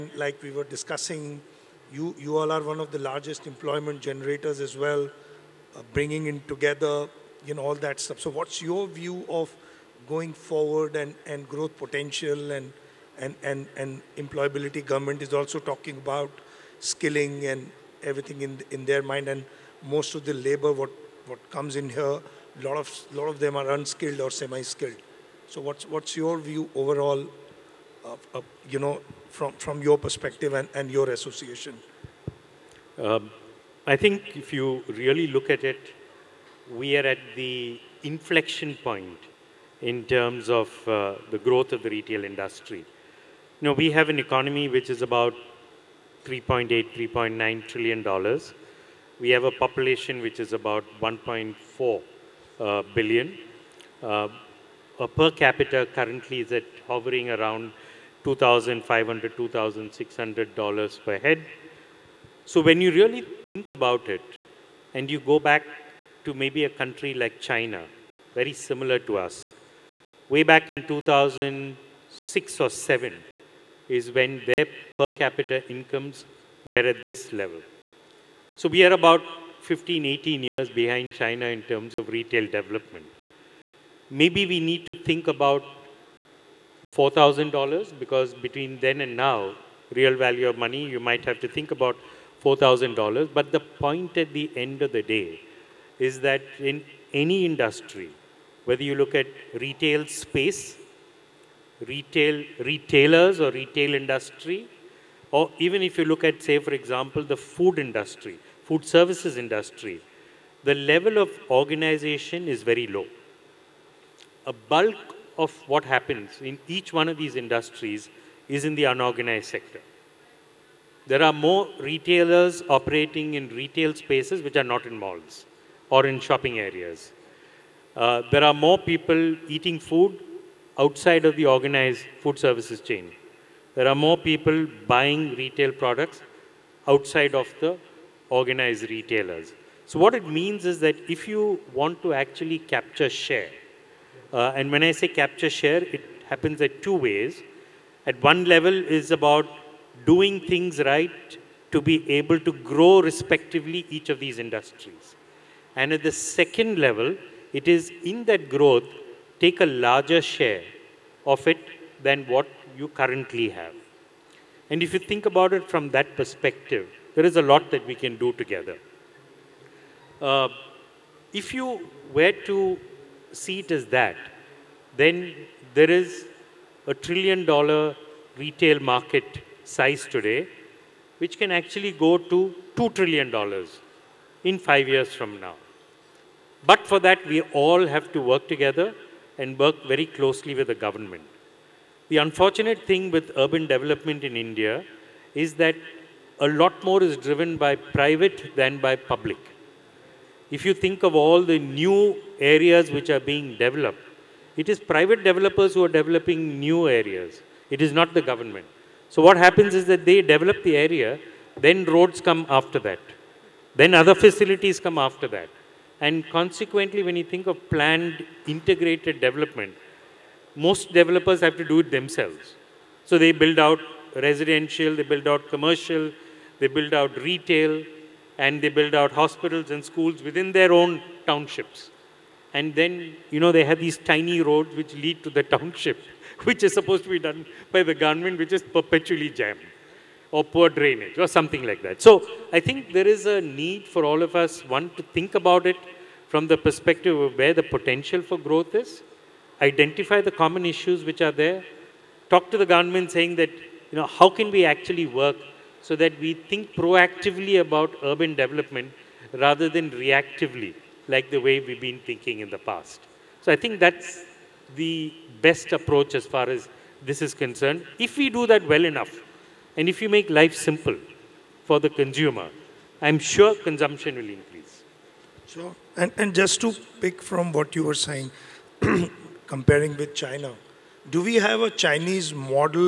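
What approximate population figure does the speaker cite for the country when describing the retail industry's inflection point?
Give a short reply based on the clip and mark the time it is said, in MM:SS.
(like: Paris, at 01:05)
1.4 billion, at 00:51.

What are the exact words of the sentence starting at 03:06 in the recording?
But for that, we all have to work together and work very closely with the government.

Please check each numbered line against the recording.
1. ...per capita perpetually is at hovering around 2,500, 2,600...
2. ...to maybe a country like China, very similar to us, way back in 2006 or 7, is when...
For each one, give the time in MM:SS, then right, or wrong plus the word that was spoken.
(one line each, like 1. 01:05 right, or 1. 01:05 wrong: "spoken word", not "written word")
1. 00:55 wrong: "currently", not "perpetually"
2. 01:06 right.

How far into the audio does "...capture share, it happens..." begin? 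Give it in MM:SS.
02:25.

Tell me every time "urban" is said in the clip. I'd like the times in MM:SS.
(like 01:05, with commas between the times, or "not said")
03:13, 04:18.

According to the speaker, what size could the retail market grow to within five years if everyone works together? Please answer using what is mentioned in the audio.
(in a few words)
$2 trillion.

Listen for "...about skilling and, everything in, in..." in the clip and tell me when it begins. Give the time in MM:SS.
00:15.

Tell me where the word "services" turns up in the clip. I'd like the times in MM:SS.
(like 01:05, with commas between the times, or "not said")
01:48, 02:12.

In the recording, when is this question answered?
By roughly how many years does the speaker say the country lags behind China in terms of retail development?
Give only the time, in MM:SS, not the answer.
01:19.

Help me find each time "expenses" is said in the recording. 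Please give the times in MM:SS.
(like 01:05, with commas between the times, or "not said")
not said.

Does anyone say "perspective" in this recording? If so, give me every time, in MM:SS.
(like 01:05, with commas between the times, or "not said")
00:29, 02:46, 04:06.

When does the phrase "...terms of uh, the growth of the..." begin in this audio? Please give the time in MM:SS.
00:40.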